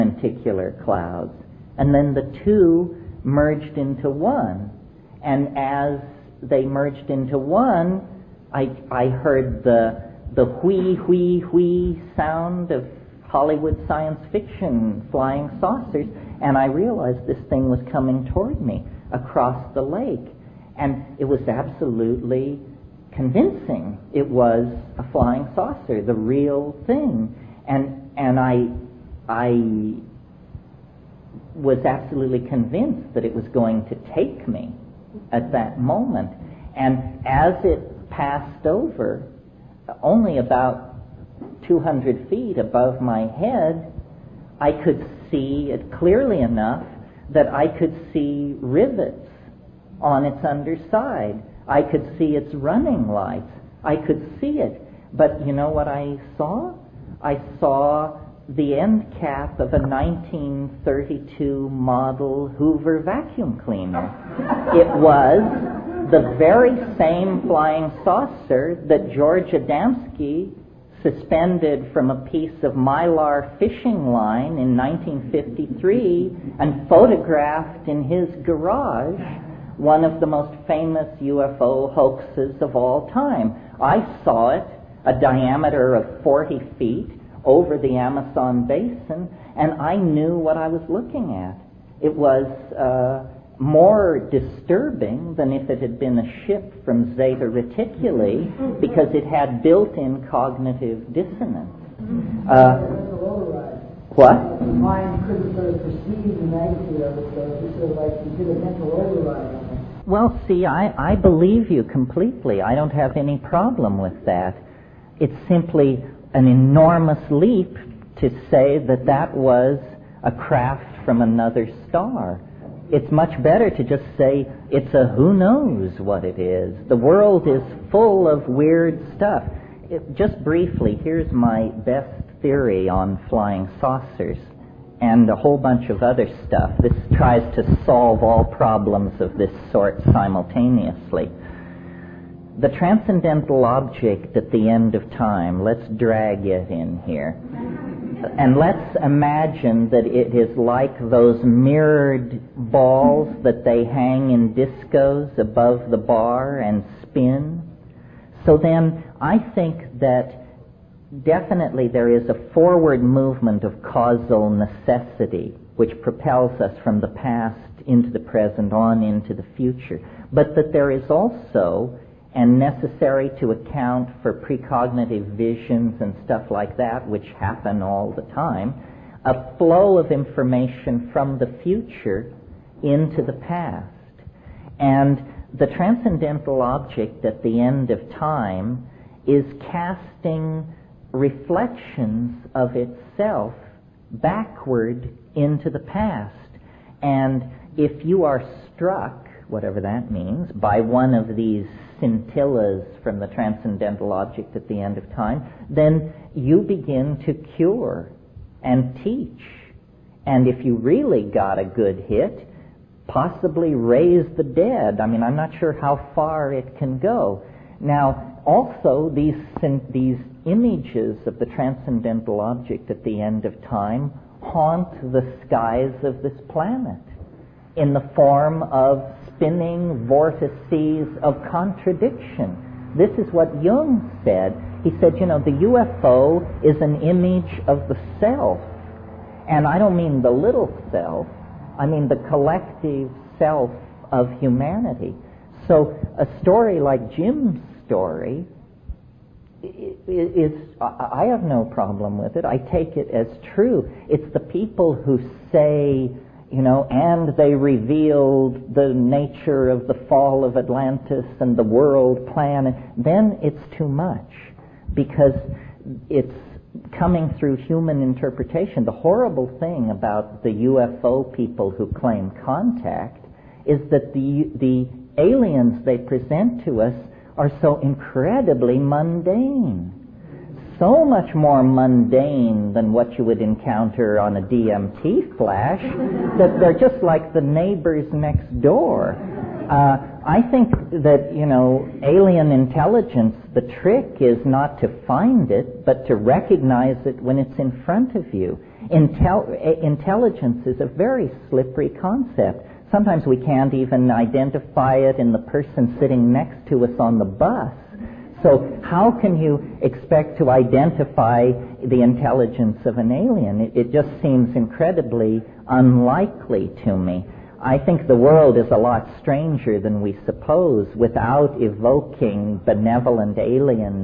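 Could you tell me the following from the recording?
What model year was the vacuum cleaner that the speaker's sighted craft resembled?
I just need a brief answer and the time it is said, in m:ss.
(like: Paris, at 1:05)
1932, at 0:59.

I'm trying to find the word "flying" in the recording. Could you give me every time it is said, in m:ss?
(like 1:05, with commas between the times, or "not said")
0:15, 0:25, 1:07, 2:13.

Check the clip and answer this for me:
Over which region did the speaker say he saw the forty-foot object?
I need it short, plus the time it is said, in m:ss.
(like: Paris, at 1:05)
Amazon basin, at 1:27.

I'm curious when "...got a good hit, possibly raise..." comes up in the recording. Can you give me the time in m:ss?
3:31.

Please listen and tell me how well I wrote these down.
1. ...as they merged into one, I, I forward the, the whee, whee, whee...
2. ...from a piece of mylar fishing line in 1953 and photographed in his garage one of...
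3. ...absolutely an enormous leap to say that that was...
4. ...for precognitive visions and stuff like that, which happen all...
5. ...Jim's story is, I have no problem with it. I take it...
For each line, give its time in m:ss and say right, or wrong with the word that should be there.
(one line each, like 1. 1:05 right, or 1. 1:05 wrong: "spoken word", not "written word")
1. 0:05 wrong: "heard", not "forward"
2. 1:11 right
3. 1:55 wrong: "simply", not "absolutely"
4. 2:54 right
5. 4:07 right.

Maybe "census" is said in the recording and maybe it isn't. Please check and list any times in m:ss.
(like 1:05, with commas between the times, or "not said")
not said.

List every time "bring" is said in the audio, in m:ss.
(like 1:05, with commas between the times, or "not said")
not said.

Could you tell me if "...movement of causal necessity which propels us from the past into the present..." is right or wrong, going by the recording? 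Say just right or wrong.
right.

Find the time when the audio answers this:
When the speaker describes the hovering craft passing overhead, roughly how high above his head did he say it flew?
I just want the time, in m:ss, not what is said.
0:41.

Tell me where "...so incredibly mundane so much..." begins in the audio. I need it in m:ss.
4:37.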